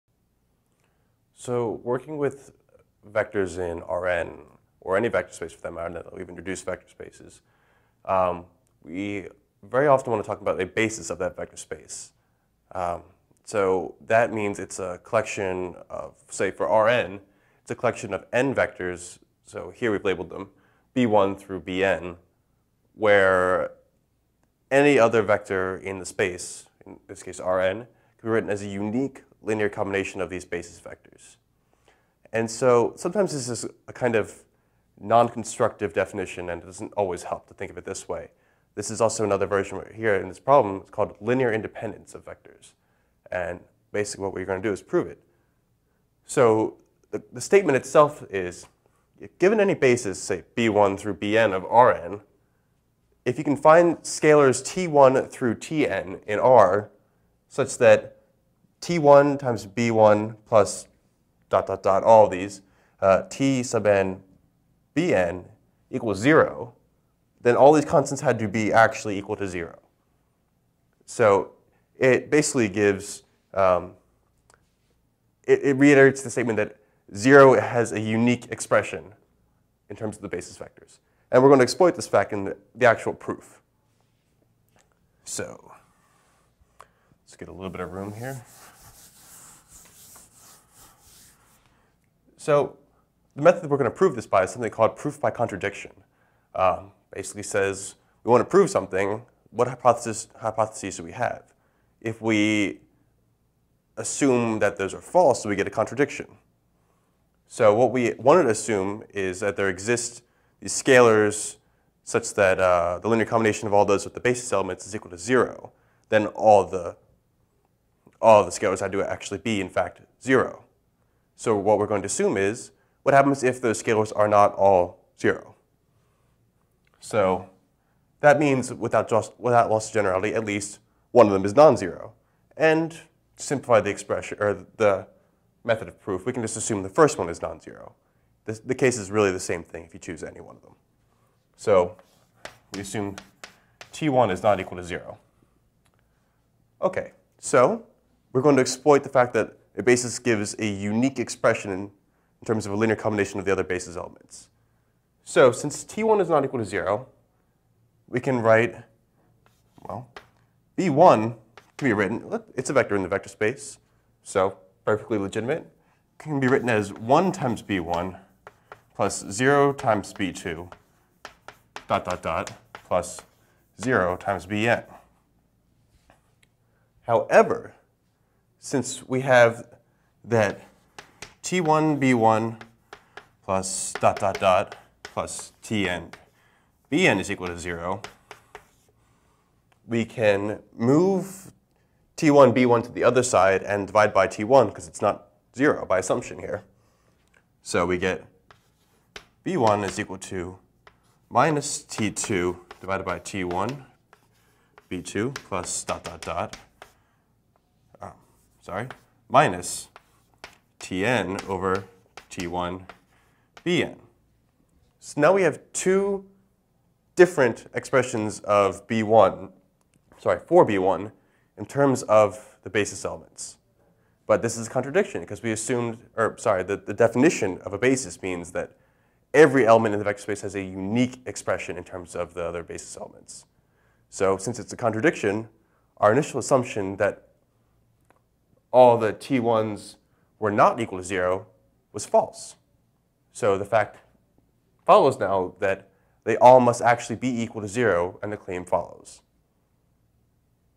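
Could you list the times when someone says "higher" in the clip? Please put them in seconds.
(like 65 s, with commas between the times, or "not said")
not said.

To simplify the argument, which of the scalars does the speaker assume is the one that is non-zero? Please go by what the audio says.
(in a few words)
the first one (t1).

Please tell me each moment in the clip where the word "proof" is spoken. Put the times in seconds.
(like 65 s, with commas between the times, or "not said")
83 s, 94 s, 135 s.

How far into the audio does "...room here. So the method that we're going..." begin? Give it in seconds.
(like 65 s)
87 s.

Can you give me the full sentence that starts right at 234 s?
So since it's a contradiction, our initial assumption that all the t1s were not equal to 0 was false.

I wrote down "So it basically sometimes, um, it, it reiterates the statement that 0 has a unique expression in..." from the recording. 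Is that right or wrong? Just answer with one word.
wrong.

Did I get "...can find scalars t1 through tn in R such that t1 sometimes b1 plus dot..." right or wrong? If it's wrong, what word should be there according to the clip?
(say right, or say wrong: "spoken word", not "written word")
wrong: "times", not "sometimes".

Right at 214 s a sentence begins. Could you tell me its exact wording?
So now we have two different expressions of b1, sorry, for b1 in terms of the basis elements.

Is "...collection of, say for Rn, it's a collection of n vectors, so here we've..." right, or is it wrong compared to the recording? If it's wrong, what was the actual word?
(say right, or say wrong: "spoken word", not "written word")
right.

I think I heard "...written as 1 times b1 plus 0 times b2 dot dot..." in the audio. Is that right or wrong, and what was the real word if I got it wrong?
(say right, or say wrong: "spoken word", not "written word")
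right.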